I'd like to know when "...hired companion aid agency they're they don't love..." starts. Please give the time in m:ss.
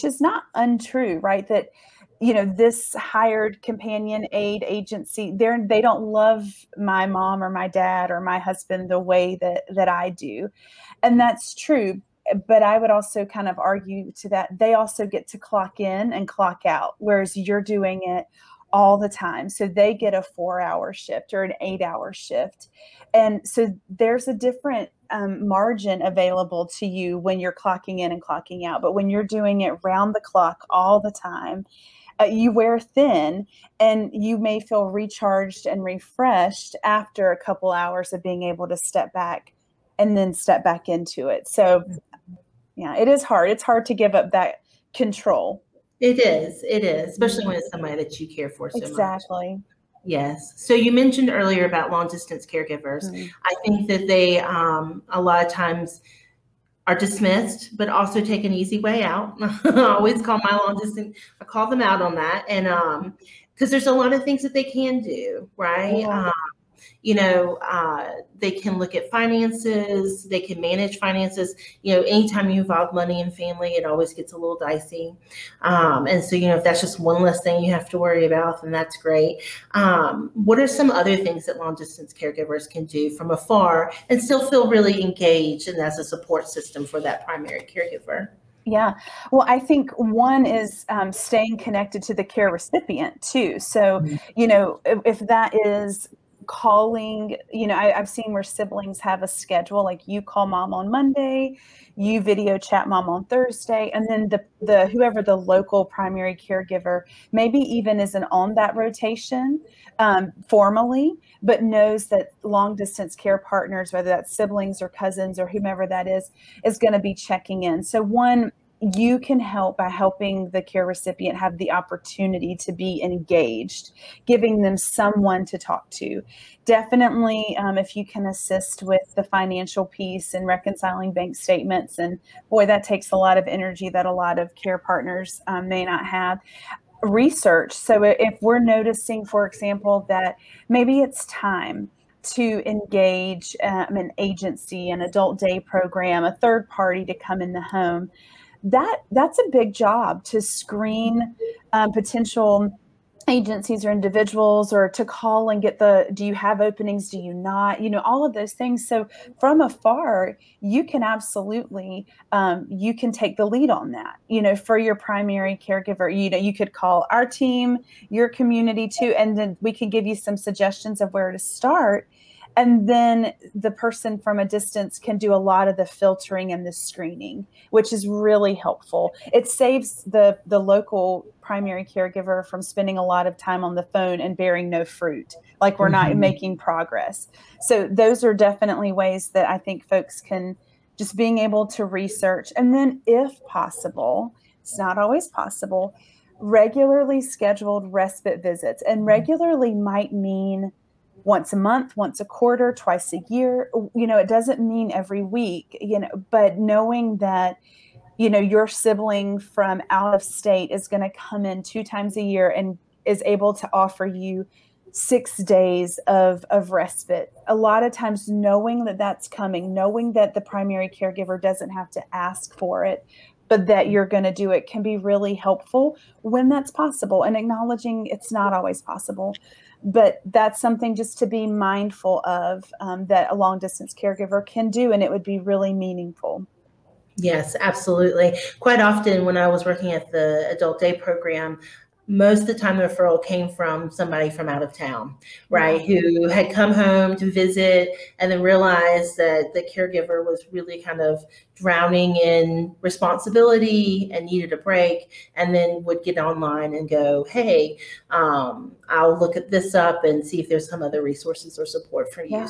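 0:02.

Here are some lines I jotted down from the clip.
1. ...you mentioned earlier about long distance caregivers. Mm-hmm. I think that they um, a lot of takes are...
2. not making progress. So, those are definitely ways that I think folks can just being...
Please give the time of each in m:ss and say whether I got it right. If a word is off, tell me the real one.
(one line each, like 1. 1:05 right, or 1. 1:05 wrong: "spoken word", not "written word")
1. 0:50 wrong: "times", not "takes"
2. 3:06 right.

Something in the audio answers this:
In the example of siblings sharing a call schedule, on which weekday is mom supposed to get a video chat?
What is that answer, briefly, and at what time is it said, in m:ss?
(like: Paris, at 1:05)
Thursday, at 1:43.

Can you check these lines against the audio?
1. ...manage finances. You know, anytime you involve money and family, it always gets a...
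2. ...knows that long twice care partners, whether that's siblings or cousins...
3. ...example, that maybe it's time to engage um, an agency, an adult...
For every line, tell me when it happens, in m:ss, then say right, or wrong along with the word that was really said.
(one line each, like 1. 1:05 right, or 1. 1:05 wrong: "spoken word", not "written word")
1. 1:10 right
2. 1:51 wrong: "distance", not "twice"
3. 2:19 right.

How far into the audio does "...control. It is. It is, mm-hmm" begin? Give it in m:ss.
0:44.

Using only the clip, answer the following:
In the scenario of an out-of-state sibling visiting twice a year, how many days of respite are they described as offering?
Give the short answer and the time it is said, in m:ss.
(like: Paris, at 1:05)
6, at 3:34.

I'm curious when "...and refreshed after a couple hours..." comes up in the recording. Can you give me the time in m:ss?
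0:35.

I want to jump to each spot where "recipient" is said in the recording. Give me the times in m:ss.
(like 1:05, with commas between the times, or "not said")
1:32, 2:00.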